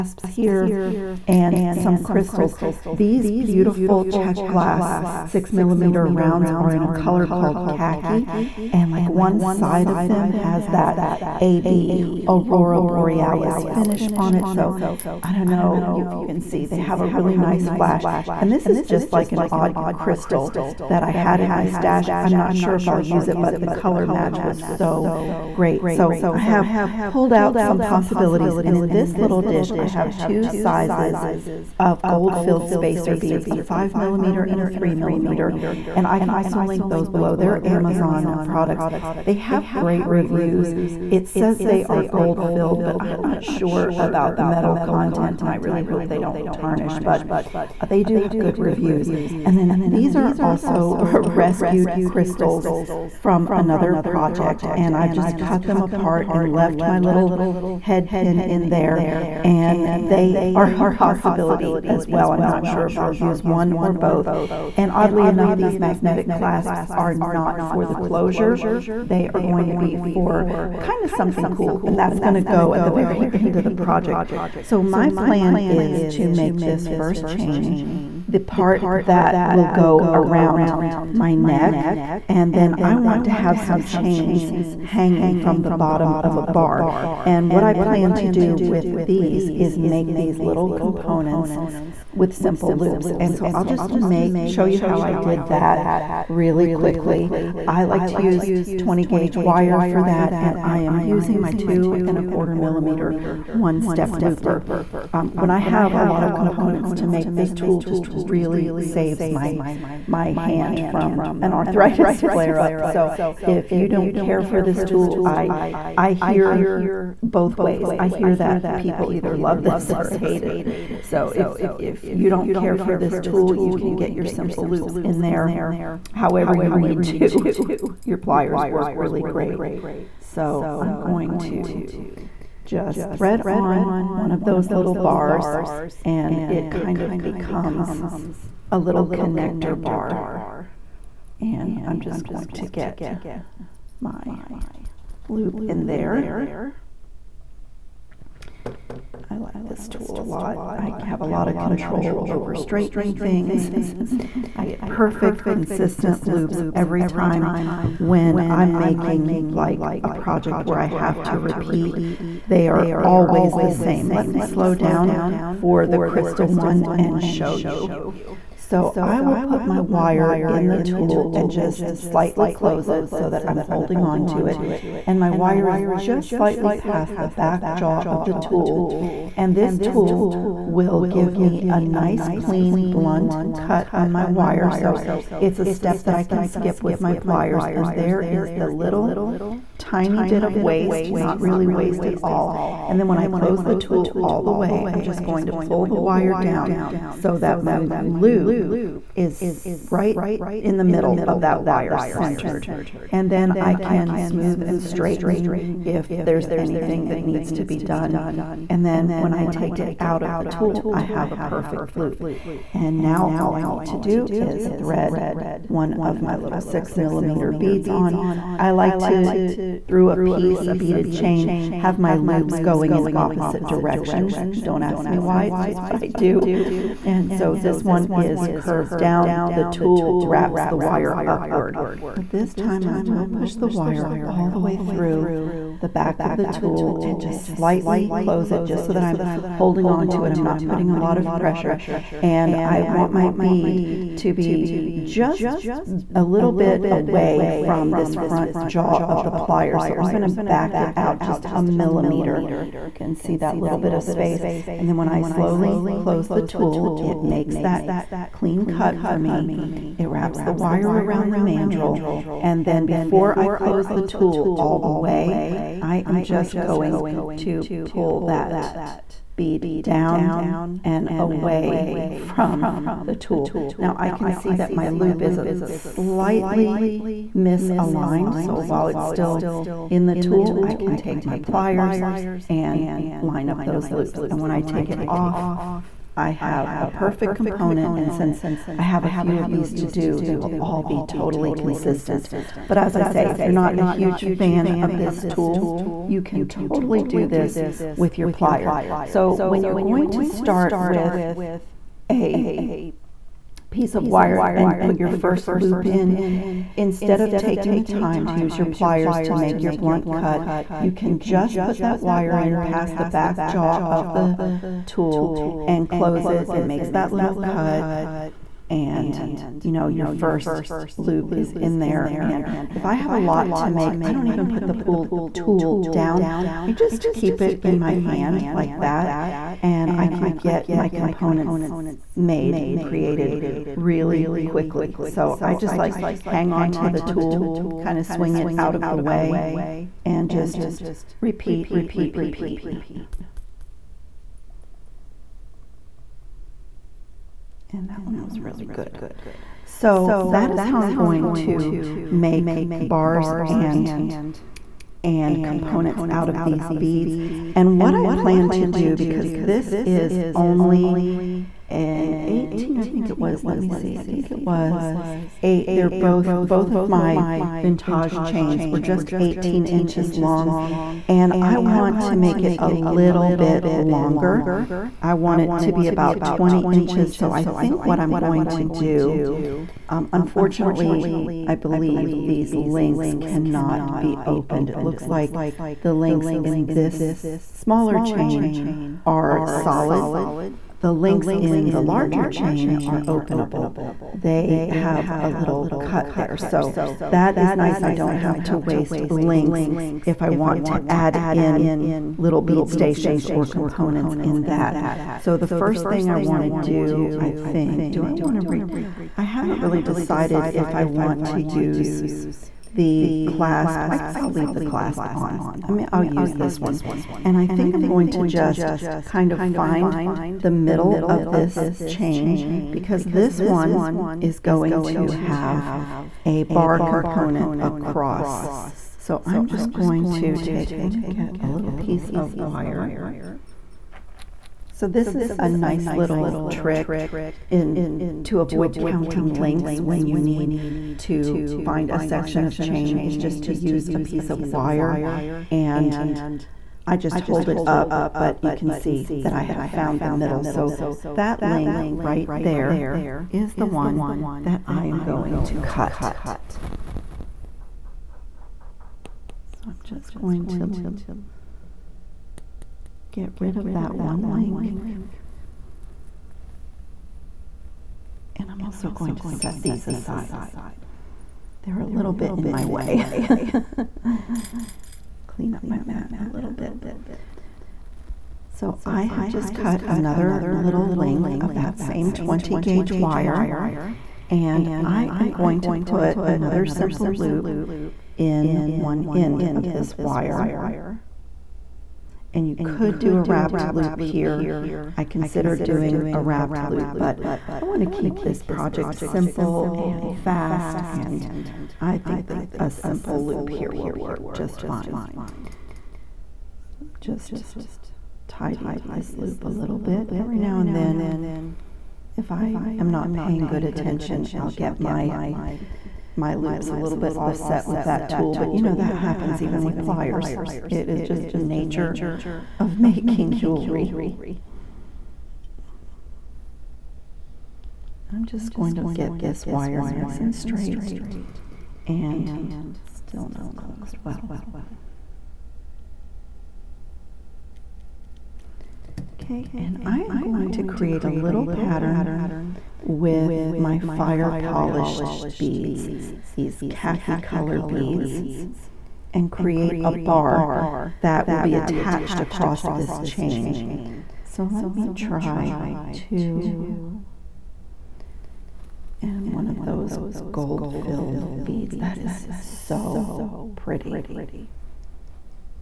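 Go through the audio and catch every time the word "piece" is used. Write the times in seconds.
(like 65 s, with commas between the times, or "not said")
220 s, 303 s, 431 s, 443 s.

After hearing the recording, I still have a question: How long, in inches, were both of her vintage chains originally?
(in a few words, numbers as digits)
18 inches.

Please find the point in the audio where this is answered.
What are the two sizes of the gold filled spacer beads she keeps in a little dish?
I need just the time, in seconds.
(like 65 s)
33 s.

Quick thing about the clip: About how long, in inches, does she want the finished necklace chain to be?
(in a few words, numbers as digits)
20 inches.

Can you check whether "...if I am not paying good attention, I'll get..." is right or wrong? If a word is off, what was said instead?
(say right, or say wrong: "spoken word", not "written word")
right.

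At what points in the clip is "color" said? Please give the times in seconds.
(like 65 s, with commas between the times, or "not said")
6 s, 23 s, 547 s.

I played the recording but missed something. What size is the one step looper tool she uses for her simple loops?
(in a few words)
2.25 mm.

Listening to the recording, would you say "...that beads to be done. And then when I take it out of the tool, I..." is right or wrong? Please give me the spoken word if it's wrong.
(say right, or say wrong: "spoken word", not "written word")
wrong: "needs", not "beads".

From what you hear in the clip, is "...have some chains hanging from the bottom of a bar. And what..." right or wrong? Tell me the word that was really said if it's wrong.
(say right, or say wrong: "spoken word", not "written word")
right.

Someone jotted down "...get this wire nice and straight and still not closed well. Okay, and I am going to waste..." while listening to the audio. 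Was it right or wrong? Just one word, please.
wrong.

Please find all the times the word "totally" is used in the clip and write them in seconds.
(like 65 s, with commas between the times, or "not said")
291 s, 296 s.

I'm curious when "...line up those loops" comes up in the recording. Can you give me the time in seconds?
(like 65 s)
283 s.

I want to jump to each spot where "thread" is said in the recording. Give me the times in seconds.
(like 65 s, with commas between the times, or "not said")
133 s, 214 s.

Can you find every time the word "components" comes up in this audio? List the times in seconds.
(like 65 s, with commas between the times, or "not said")
90 s, 106 s, 287 s, 330 s, 355 s, 403 s, 426 s.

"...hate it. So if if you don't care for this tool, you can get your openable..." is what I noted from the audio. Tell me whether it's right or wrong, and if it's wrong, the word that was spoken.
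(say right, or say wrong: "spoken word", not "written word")
wrong: "simple", not "openable".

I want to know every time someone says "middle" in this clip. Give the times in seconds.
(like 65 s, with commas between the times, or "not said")
200 s, 420 s, 450 s.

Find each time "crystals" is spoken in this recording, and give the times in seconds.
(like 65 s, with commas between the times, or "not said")
2 s, 19 s, 52 s, 165 s.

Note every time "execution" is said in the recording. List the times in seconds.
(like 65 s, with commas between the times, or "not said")
not said.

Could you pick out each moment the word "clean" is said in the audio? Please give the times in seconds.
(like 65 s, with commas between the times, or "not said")
182 s, 258 s, 475 s.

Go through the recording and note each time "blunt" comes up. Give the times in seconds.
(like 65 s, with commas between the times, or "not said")
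182 s, 309 s.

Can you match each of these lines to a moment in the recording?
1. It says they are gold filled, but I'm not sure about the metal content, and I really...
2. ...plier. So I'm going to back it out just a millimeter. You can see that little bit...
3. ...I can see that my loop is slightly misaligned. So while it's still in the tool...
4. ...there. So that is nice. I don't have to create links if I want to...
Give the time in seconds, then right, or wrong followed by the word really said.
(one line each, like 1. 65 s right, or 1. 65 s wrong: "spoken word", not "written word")
1. 41 s right
2. 249 s right
3. 273 s right
4. 396 s wrong: "waste", not "create".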